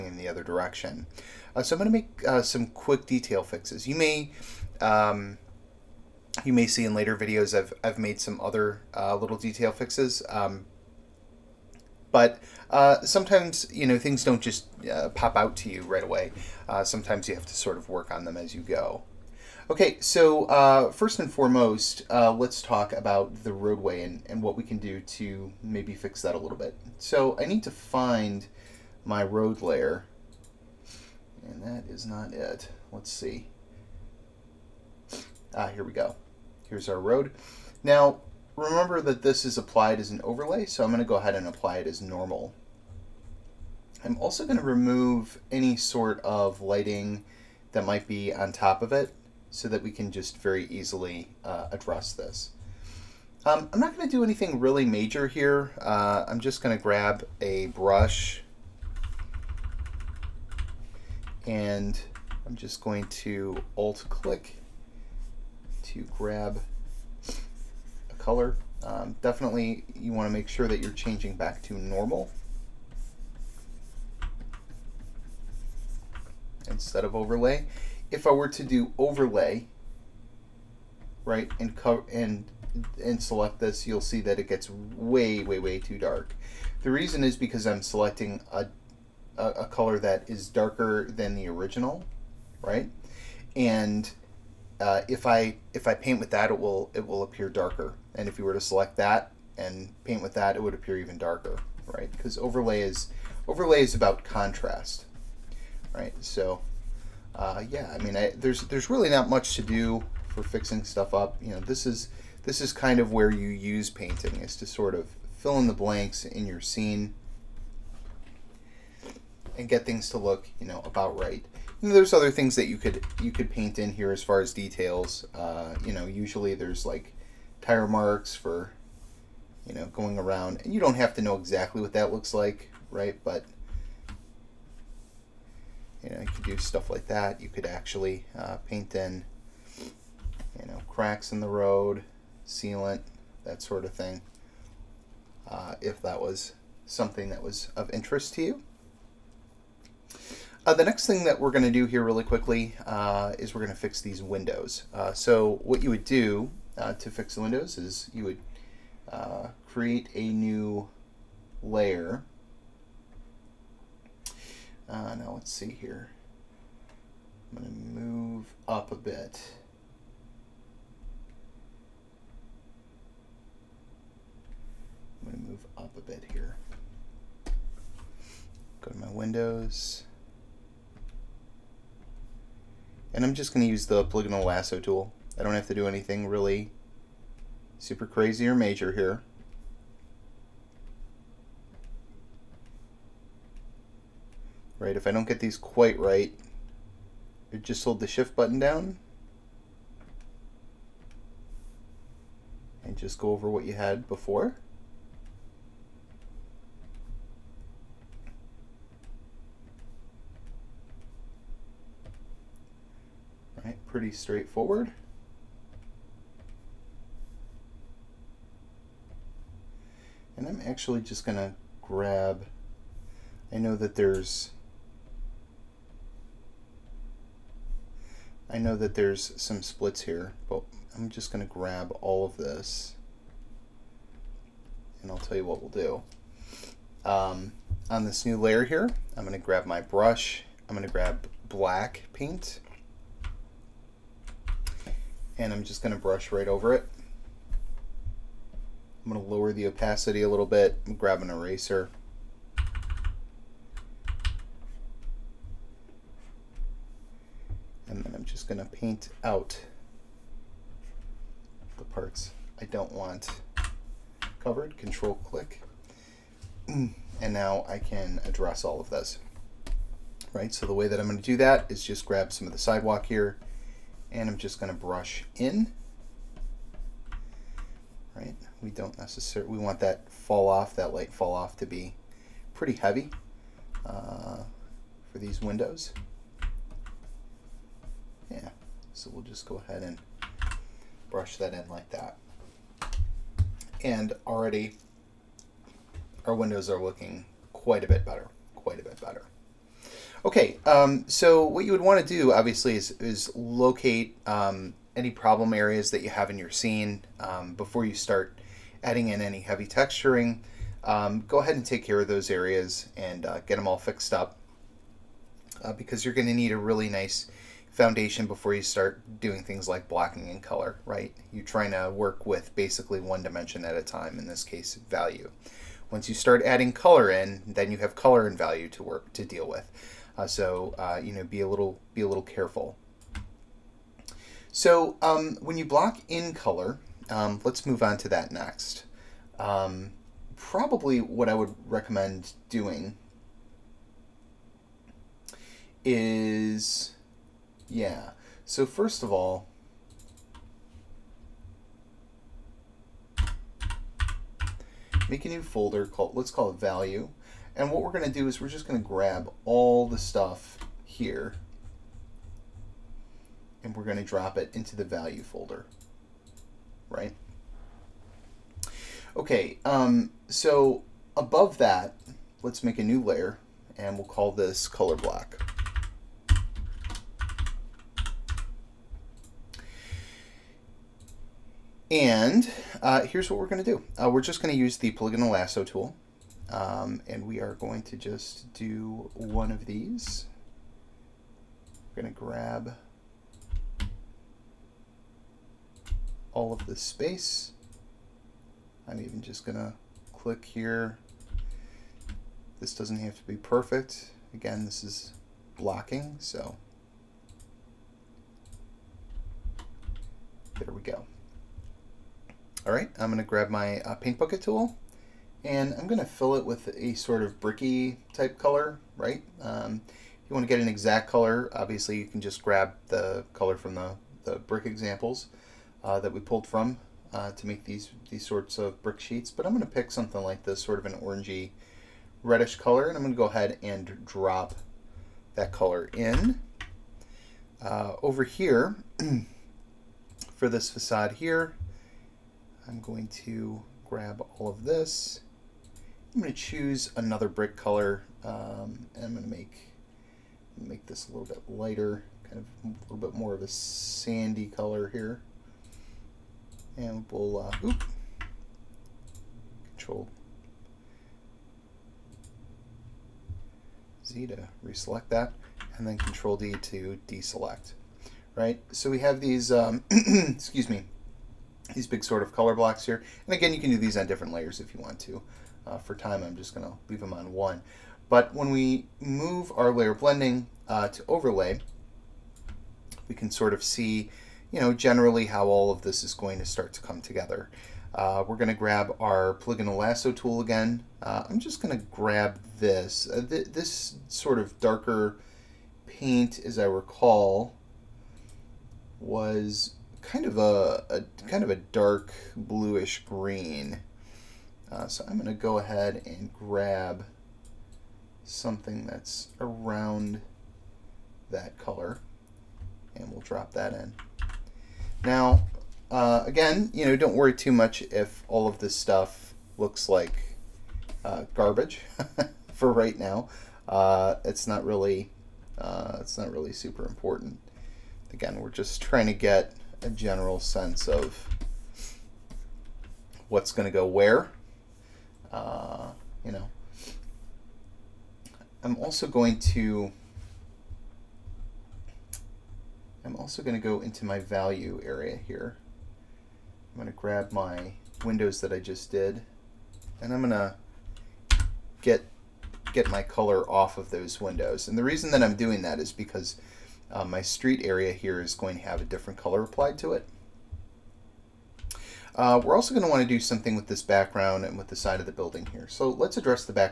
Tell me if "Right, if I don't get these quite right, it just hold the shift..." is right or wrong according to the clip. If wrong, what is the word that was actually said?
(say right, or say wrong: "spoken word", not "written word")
right.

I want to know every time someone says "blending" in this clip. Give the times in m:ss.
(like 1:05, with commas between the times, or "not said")
7:59.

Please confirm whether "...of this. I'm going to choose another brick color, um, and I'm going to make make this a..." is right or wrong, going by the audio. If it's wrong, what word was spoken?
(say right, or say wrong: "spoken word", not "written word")
right.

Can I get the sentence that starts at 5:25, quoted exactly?
Once you start adding color in, then you have color and value to work to deal with.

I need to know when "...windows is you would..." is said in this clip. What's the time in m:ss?
2:37.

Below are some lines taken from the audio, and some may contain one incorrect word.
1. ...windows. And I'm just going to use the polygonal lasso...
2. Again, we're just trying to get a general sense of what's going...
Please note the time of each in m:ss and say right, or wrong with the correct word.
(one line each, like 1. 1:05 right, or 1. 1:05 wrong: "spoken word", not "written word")
1. 2:59 right
2. 8:48 right.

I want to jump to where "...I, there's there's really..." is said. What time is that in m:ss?
1:48.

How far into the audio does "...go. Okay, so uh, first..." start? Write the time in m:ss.
0:18.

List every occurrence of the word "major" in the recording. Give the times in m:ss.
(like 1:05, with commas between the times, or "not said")
0:54, 3:08.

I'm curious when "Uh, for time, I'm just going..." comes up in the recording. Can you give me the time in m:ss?
7:55.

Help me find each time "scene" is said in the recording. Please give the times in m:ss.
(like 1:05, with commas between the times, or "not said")
1:56, 5:06.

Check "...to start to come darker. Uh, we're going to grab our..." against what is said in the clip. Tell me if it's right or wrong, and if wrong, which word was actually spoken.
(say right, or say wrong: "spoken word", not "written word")
wrong: "together", not "darker".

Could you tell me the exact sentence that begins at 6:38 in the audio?
I'm even just going to click here.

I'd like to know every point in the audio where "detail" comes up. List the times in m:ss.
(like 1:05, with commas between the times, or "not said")
0:03, 0:09, 2:04.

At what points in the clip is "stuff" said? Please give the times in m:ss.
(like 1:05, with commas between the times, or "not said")
1:50, 2:16, 5:59, 8:38.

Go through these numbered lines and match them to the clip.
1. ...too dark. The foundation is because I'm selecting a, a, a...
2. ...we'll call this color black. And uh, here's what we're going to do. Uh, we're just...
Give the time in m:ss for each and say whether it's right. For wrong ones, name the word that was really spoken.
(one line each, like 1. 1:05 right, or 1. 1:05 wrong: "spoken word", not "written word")
1. 1:25 wrong: "reason", not "foundation"
2. 6:13 right.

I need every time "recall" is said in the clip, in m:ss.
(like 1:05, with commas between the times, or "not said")
8:16.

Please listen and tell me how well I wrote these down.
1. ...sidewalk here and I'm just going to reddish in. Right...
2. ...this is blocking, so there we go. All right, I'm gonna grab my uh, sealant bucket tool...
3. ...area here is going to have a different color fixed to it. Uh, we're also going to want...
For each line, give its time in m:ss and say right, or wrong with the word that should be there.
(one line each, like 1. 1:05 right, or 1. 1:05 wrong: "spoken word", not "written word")
1. 4:32 wrong: "brush", not "reddish"
2. 6:44 wrong: "paint", not "sealant"
3. 9:17 wrong: "applied", not "fixed".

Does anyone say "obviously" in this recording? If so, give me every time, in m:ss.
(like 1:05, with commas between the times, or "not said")
5:02, 7:01.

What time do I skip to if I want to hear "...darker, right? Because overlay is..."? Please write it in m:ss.
1:41.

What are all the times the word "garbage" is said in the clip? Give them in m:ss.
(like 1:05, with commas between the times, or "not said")
8:41.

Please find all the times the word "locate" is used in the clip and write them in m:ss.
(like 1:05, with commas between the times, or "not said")
5:03.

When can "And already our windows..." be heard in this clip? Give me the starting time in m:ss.
4:53.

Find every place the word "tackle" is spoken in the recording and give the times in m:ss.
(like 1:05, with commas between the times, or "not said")
not said.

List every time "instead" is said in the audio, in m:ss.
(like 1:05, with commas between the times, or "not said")
1:16.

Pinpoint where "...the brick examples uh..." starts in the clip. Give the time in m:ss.
7:04.